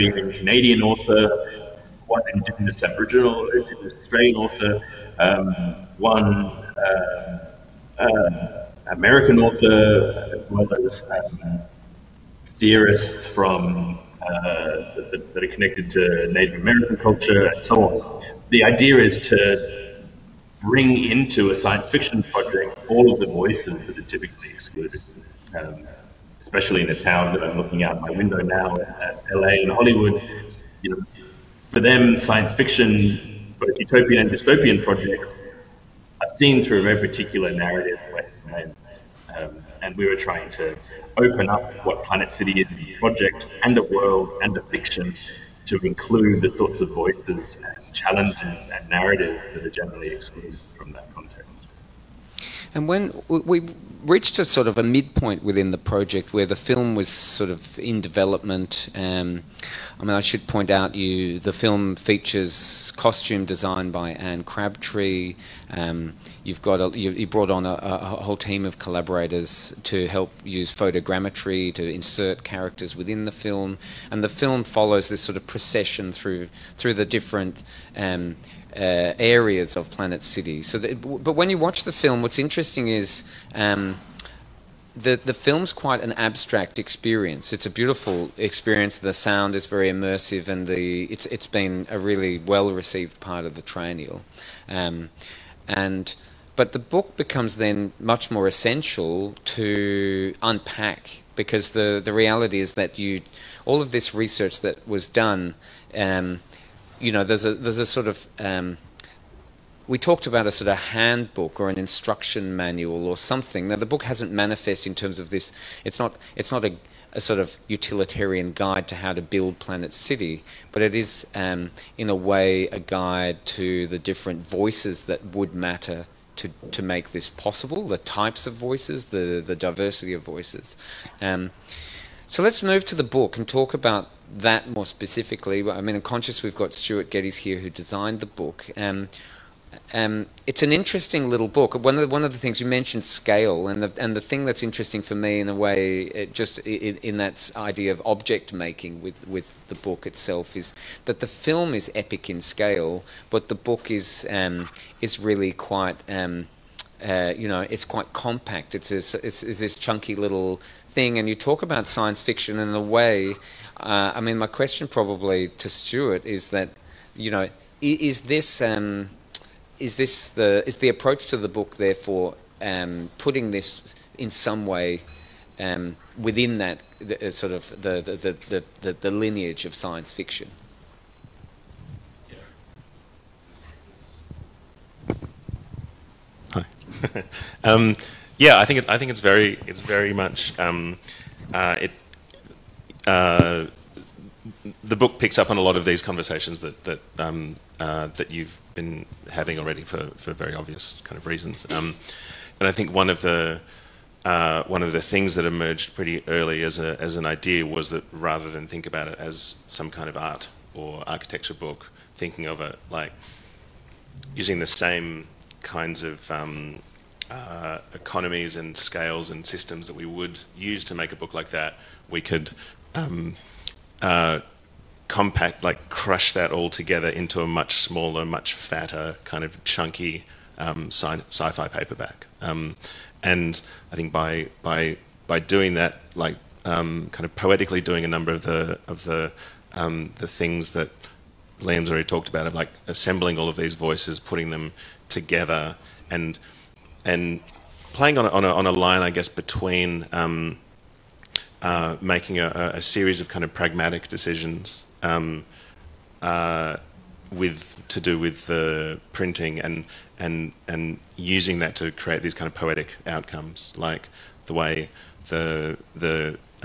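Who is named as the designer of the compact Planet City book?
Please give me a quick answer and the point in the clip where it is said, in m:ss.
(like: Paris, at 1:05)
Stuart Geddes, at 2:16.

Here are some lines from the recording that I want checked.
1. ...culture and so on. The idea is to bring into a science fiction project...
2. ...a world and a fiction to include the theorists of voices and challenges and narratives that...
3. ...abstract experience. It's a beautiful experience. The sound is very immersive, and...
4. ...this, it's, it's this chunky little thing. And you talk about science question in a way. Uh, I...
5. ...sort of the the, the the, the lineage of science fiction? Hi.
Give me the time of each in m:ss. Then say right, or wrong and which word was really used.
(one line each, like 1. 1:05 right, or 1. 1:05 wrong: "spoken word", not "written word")
1. 0:17 right
2. 0:43 wrong: "sorts", not "theorists"
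3. 1:26 right
4. 2:38 wrong: "fiction", not "question"
5. 2:57 right.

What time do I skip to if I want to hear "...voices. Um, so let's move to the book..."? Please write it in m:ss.
2:10.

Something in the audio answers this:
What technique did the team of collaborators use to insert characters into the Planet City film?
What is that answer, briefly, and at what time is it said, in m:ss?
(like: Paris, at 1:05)
photogrammetry, at 1:10.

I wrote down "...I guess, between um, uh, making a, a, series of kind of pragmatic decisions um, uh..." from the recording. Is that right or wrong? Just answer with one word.
right.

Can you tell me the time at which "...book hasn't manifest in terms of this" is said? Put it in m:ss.
1:53.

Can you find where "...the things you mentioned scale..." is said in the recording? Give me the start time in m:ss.
2:22.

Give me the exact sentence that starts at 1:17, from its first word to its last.
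Um, uh, areas of Planet City.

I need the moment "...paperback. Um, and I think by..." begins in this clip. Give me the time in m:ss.
3:51.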